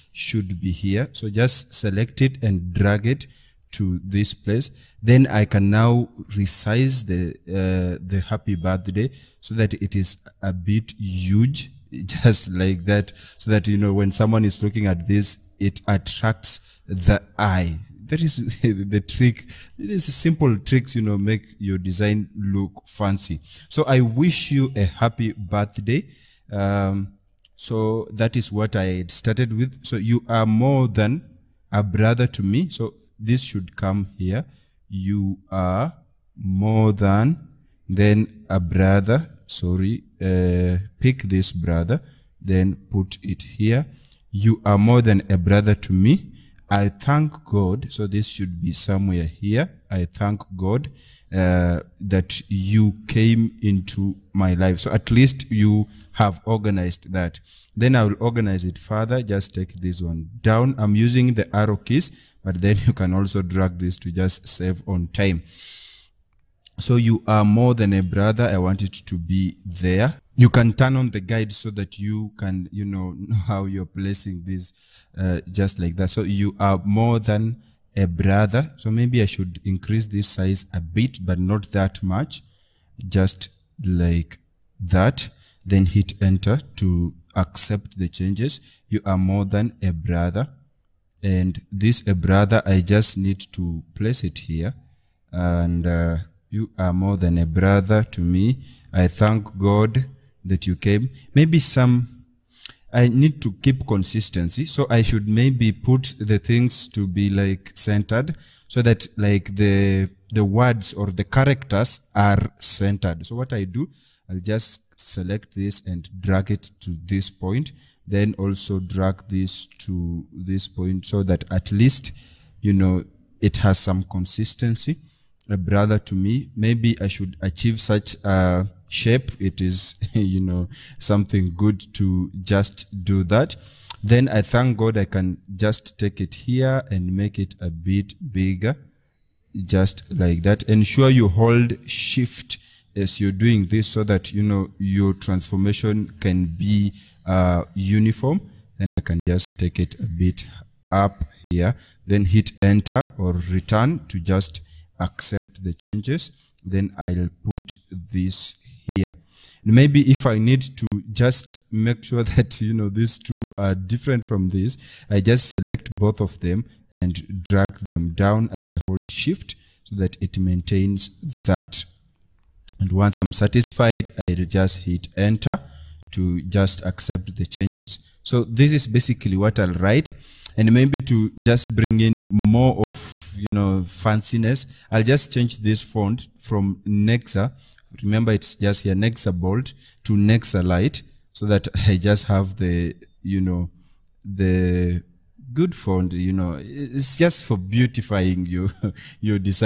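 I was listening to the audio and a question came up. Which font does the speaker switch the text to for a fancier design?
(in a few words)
Nexa Light.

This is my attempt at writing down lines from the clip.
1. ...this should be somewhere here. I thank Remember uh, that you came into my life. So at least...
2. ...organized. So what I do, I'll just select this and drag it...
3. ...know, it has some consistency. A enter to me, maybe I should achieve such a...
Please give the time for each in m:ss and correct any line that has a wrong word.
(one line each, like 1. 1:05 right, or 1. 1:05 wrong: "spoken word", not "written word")
1. 0:48 wrong: "God", not "Remember"
2. 1:52 wrong: "centered", not "organized"
3. 2:02 wrong: "brother", not "enter".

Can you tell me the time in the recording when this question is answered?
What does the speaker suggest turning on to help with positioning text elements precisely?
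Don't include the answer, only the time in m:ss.
1:11.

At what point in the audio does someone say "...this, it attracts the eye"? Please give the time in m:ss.
0:15.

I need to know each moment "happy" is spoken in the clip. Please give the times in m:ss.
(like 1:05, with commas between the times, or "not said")
0:08, 0:24.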